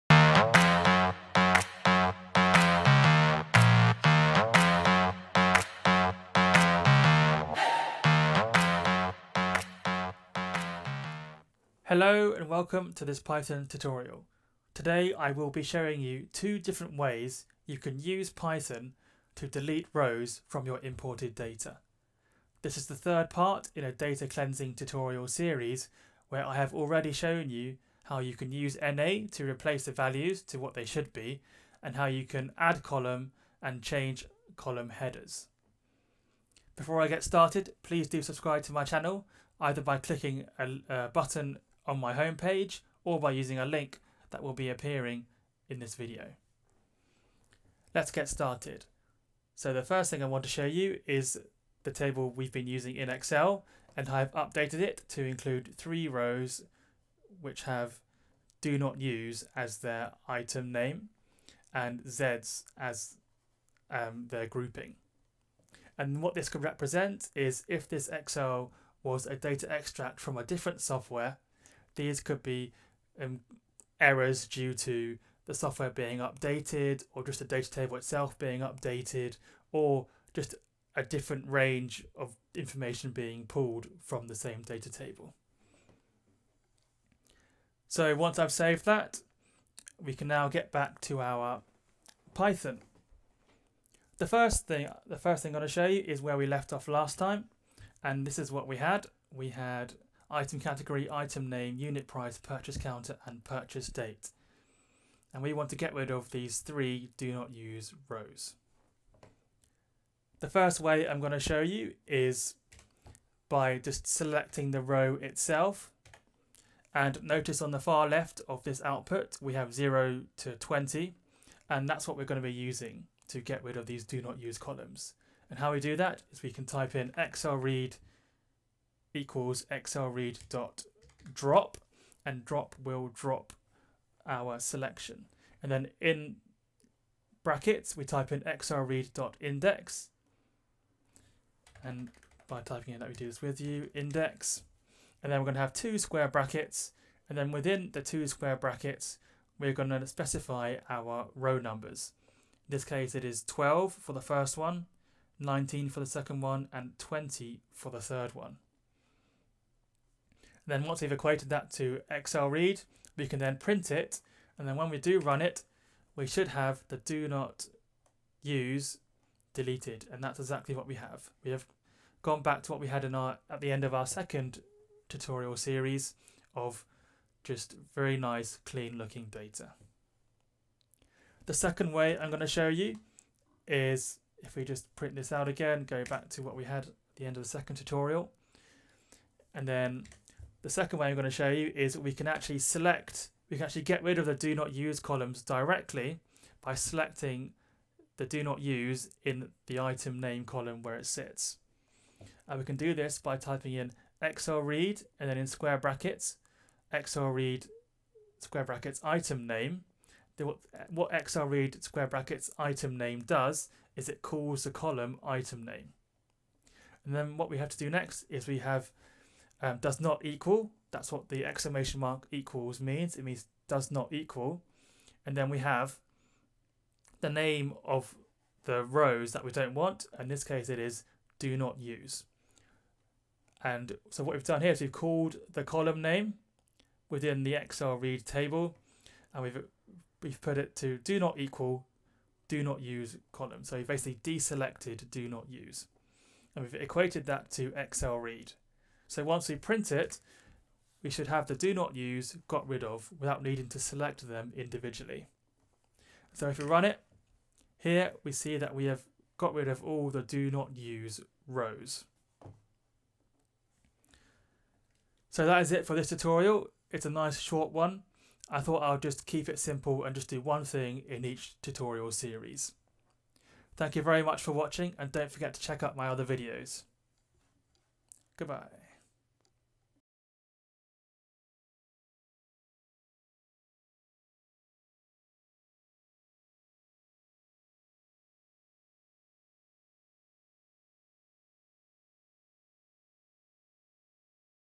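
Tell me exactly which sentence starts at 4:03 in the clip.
So we basically deselected do not use.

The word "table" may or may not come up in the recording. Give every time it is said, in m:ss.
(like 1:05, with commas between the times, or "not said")
0:51, 1:17, 1:24, 3:58.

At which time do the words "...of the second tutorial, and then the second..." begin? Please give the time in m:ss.
3:07.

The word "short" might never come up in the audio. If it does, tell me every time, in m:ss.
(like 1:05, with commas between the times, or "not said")
4:27.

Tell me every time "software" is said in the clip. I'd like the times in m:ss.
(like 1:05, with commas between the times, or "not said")
1:10, 1:15.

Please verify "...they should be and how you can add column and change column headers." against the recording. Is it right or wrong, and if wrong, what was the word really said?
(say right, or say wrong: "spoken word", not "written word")
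right.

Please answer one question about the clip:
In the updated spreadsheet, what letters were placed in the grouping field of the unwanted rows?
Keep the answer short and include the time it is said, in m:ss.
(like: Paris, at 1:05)
Zs, at 1:02.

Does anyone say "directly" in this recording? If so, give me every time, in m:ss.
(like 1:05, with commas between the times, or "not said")
3:15.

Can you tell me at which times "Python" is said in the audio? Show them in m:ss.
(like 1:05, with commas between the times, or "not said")
0:13, 0:18, 1:32.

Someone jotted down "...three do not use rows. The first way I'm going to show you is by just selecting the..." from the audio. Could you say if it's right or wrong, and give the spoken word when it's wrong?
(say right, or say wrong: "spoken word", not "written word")
right.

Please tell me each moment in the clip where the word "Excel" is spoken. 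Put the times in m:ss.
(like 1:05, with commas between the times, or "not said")
0:53, 1:08, 2:42, 3:57, 4:07.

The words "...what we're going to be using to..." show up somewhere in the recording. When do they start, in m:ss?
2:02.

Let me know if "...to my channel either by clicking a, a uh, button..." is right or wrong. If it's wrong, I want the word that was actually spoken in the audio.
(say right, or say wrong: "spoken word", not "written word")
right.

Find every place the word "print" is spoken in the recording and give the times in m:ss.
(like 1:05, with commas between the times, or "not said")
2:43, 3:04, 4:09.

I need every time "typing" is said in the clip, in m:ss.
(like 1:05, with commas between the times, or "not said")
2:22, 3:23.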